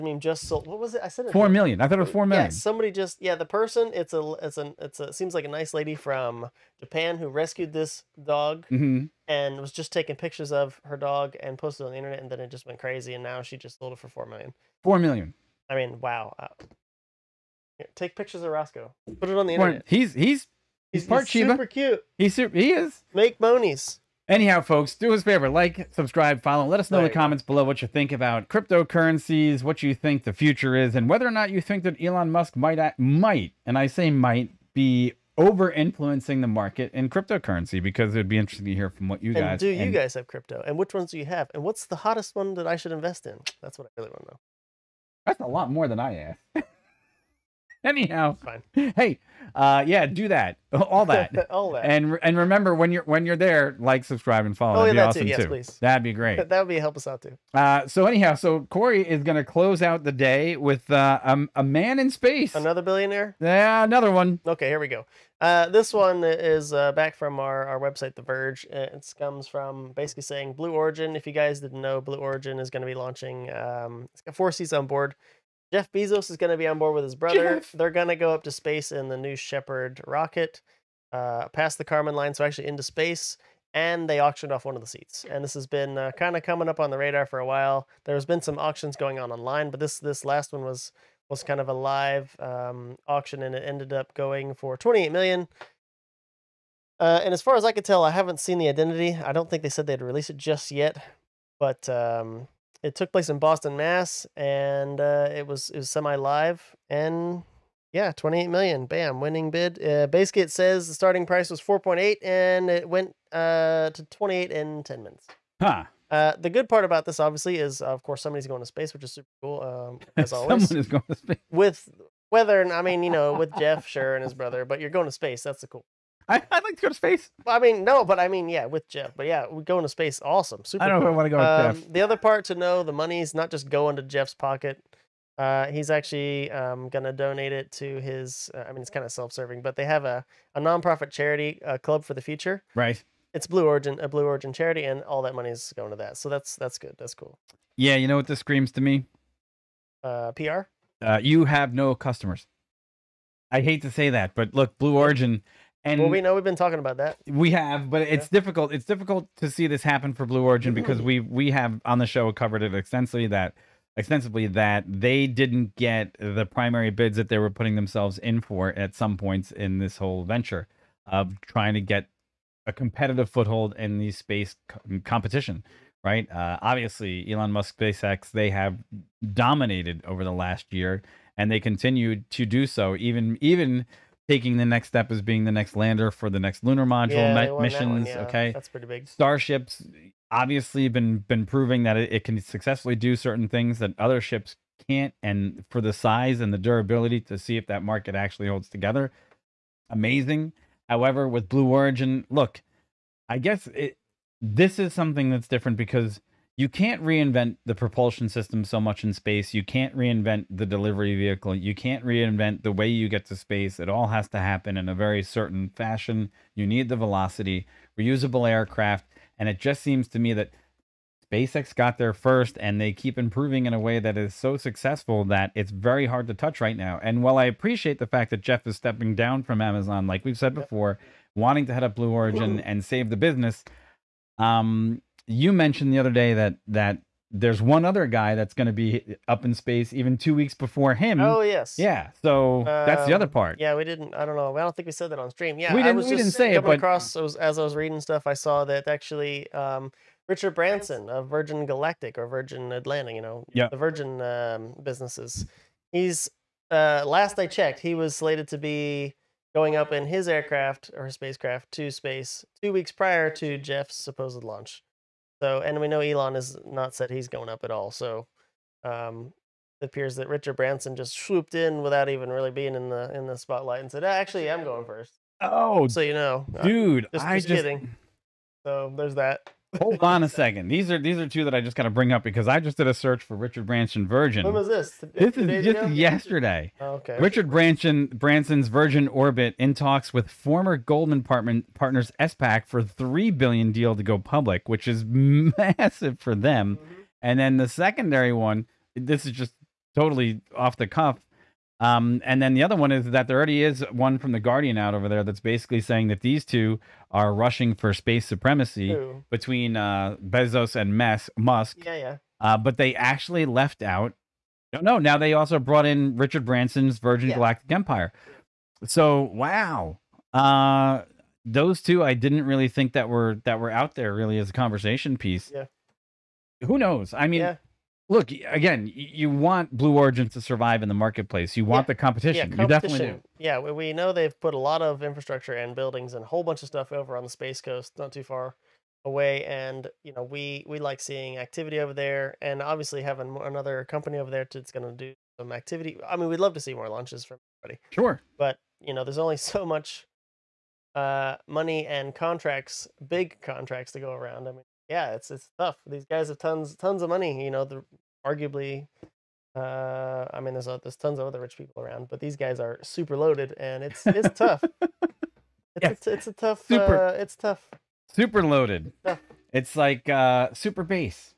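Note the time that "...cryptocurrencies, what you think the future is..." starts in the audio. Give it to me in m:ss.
0:28.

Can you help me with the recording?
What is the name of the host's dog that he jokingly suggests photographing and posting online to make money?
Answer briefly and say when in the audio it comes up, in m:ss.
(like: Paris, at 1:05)
Roscoe, at 0:18.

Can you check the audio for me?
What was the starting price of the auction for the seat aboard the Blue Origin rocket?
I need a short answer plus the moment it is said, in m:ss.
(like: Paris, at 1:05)
4.8, at 1:51.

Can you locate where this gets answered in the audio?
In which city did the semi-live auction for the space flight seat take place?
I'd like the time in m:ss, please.
1:43.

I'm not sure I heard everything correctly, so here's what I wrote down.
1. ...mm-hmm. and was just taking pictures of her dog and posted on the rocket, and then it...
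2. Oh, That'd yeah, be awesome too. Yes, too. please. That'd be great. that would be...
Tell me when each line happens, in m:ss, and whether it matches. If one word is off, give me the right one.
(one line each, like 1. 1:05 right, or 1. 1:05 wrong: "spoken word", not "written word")
1. 0:08 wrong: "internet", not "rocket"
2. 0:54 right.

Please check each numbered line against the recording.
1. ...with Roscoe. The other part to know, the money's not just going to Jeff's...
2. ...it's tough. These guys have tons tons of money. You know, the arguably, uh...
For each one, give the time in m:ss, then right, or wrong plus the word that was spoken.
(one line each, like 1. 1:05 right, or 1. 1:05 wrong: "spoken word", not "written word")
1. 2:11 wrong: "Jeff", not "Roscoe"
2. 5:55 right.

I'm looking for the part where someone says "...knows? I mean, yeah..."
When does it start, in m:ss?
5:26.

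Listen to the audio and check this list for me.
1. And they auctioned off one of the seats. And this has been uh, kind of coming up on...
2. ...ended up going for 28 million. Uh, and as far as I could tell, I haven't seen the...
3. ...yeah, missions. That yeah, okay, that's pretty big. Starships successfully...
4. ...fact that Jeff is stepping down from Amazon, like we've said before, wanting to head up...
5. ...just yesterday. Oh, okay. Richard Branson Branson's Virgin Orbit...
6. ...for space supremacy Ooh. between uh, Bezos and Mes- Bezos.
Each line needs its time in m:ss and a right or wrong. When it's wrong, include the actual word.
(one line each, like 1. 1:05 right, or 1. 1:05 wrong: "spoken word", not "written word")
1. 1:23 right
2. 1:33 right
3. 3:07 wrong: "obviously", not "successfully"
4. 3:48 right
5. 4:45 right
6. 5:07 wrong: "Musk", not "Bezos".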